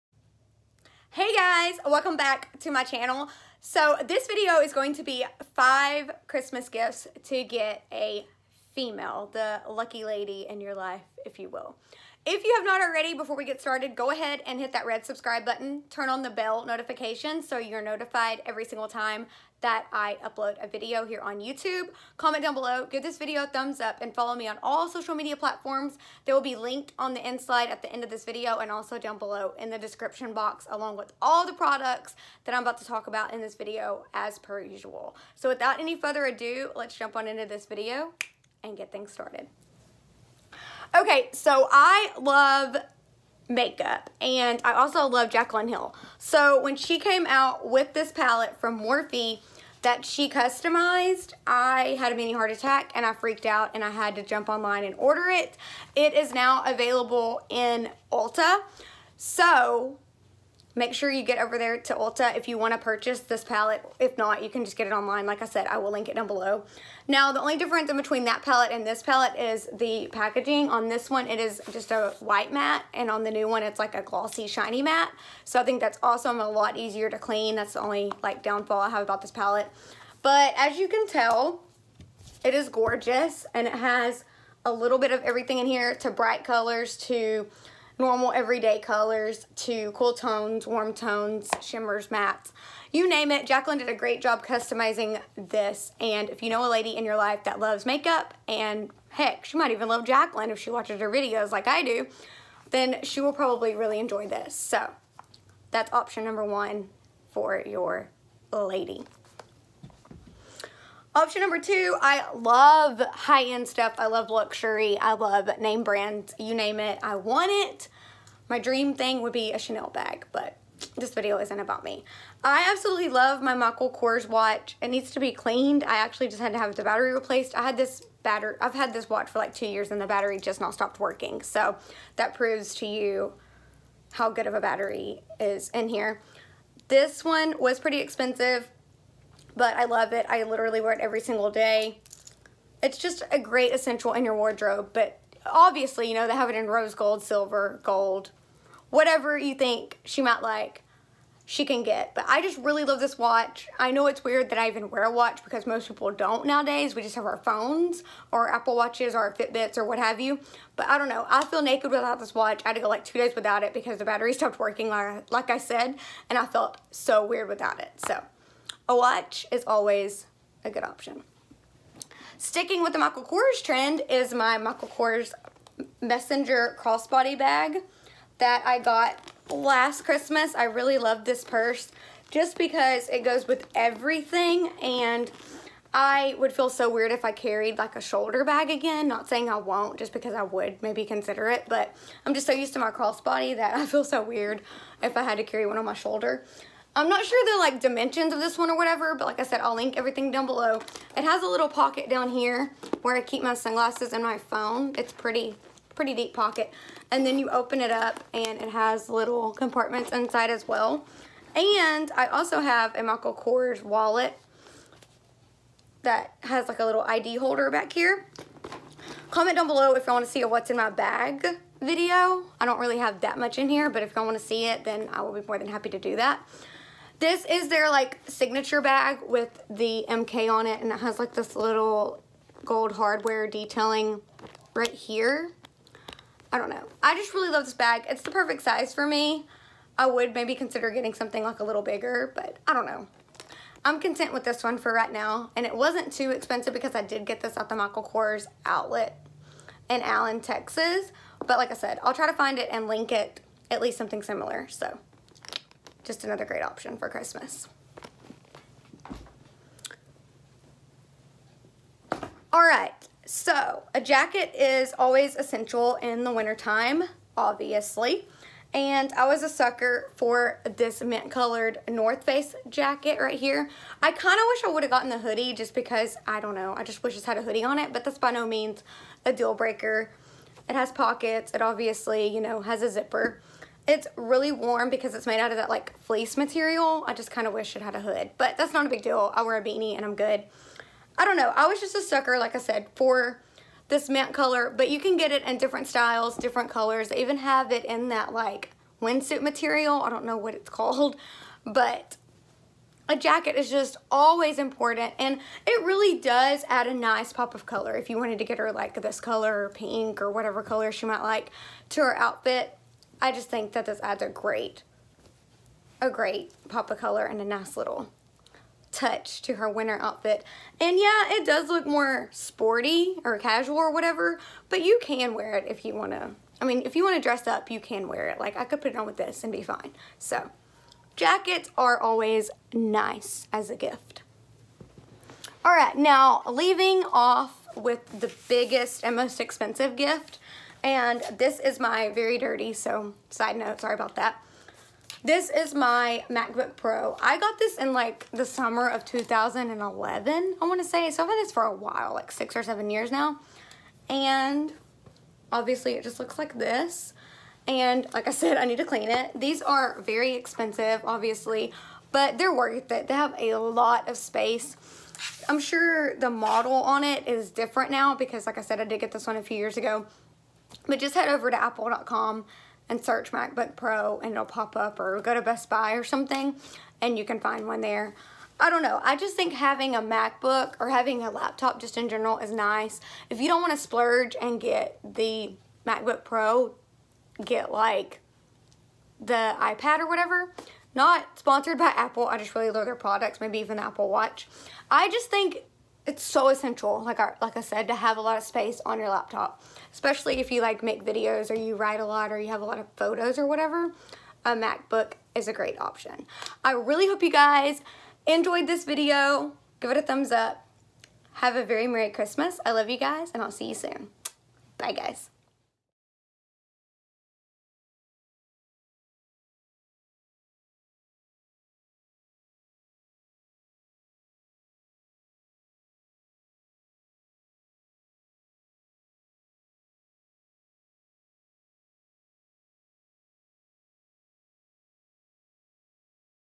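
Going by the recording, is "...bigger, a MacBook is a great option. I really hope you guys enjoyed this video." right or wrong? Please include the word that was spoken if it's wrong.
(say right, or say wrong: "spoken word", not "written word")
wrong: "whatever", not "bigger".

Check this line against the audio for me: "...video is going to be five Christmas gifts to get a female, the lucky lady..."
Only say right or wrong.
right.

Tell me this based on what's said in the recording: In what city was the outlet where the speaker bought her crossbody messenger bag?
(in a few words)
Allen, Texas.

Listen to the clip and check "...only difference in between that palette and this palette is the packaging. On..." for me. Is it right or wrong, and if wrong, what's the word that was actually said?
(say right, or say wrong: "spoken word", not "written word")
right.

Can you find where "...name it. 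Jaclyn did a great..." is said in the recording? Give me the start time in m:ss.
1:33.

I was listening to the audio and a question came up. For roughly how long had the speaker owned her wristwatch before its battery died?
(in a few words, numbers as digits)
2 years.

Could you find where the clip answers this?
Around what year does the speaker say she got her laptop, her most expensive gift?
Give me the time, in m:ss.
5:49.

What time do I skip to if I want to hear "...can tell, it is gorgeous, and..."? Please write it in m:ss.
1:20.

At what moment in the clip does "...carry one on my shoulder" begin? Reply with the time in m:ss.
3:15.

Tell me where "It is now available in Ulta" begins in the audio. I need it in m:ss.
0:55.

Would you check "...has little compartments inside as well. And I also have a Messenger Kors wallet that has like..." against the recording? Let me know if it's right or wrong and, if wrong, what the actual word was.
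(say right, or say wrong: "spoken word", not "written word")
wrong: "Michael", not "Messenger".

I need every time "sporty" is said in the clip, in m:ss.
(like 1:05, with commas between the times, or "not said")
5:22.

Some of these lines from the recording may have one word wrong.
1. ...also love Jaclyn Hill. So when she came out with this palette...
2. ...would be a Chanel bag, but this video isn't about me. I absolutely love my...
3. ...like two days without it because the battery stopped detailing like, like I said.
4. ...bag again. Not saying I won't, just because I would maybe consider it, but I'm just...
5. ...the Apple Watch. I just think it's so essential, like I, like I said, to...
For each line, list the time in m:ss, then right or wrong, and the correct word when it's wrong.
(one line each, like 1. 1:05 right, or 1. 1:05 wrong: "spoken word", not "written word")
1. 0:44 right
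2. 1:59 right
3. 2:42 wrong: "working", not "detailing"
4. 3:08 right
5. 6:33 right.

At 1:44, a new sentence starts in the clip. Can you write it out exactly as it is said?
So that's option number one for your lady.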